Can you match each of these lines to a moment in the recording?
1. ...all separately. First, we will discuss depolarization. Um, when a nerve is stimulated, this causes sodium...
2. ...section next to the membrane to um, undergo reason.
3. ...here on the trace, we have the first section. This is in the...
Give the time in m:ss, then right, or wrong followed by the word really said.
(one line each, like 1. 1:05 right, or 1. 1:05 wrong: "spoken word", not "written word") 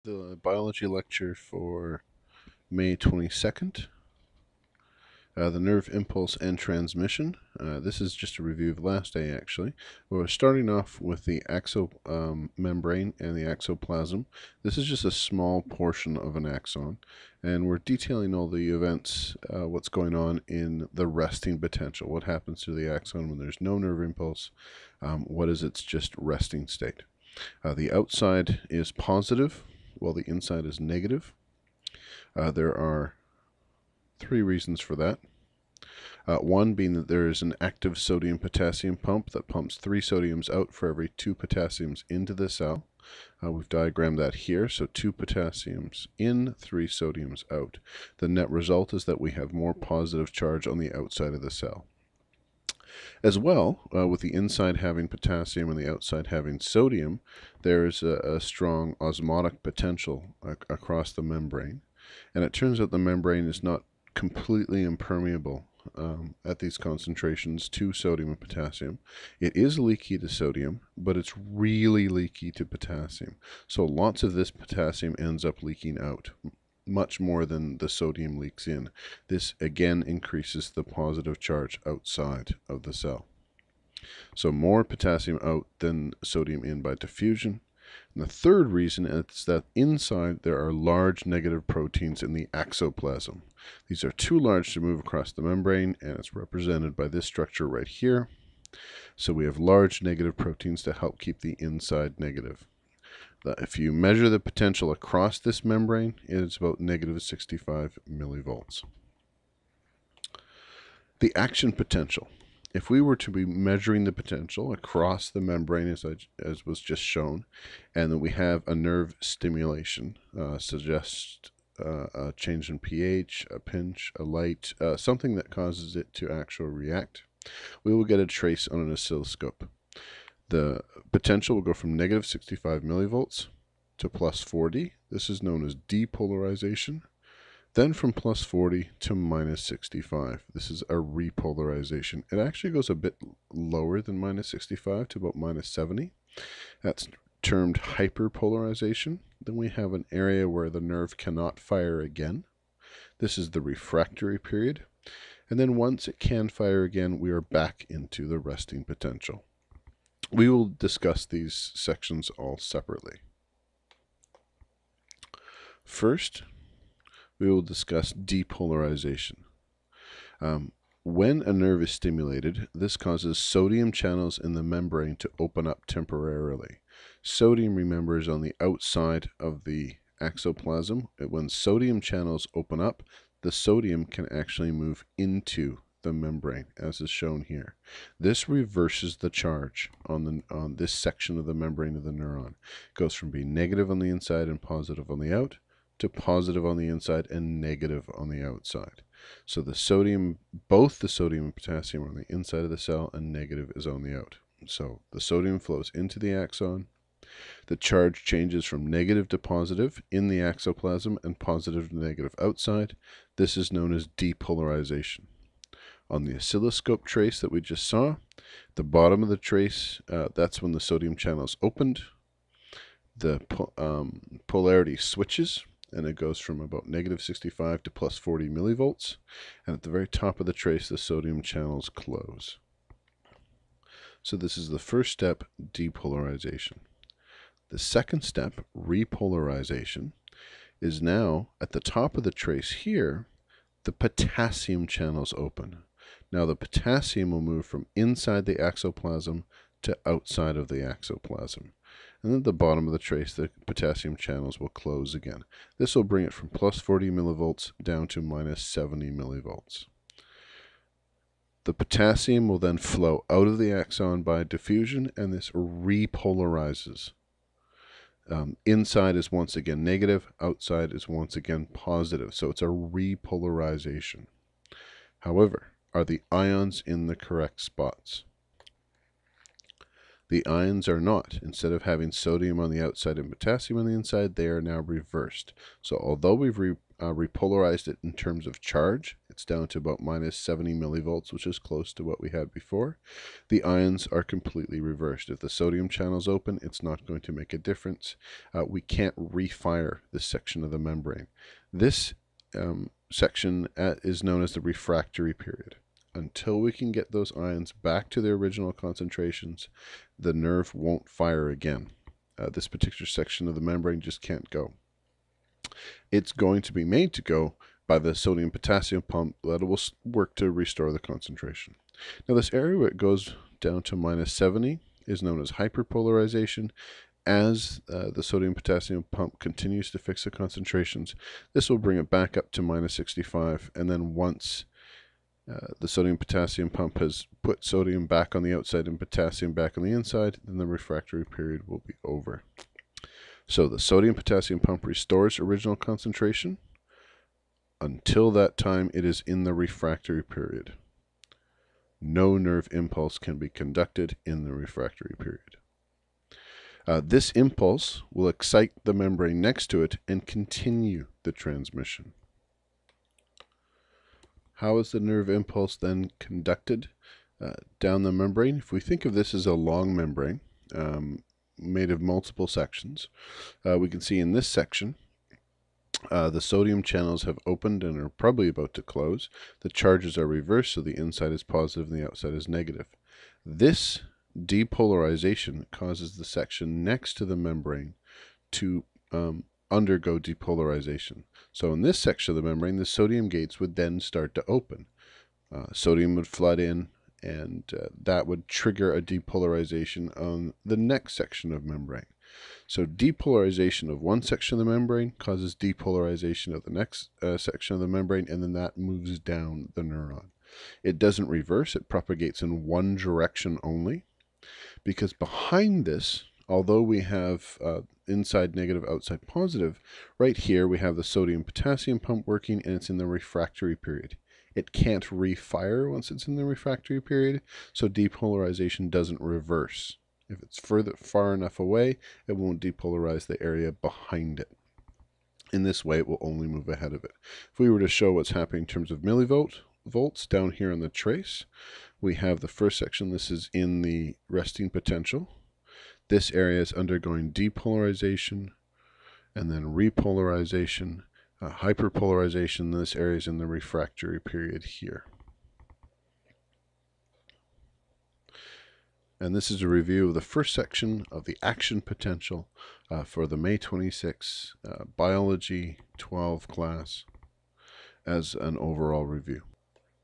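1. 2:42 right
2. 6:26 wrong: "depolarization", not "reason"
3. 7:20 right.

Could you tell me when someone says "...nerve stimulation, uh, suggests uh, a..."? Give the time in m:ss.
1:58.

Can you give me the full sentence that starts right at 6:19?
The charges are reversed, so the inside is positive and the outside is negative.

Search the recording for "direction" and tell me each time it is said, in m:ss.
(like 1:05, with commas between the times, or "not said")
6:52.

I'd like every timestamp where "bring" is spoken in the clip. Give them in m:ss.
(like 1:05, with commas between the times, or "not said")
4:16, 5:31.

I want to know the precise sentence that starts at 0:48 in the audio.
The net result is that we have more positive charge on the outside of the cell.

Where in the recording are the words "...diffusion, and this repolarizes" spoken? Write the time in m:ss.
4:24.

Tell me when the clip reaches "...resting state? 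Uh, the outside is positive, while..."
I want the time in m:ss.
0:26.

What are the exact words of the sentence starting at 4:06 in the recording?
Now the potassium will move from inside the axoplasm to outside of the axoplasm.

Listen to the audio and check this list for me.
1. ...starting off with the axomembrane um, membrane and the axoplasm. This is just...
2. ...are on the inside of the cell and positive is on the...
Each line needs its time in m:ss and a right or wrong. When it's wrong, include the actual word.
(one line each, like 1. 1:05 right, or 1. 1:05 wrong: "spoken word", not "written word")
1. 0:10 right
2. 3:22 wrong: "negative", not "positive".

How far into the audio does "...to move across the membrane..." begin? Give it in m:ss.
1:34.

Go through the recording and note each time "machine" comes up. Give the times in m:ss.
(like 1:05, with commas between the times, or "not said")
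not said.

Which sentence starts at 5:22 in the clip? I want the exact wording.
Now, this area where it goes down to minus 70 is known as hyperpolarization.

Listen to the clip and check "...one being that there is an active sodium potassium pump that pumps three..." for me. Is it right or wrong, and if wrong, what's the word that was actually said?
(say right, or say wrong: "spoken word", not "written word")
right.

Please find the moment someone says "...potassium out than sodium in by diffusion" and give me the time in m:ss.
1:24.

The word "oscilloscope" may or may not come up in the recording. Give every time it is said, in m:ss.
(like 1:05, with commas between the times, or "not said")
2:08, 3:36.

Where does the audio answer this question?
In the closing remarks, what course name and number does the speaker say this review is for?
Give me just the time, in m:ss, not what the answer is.
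7:44.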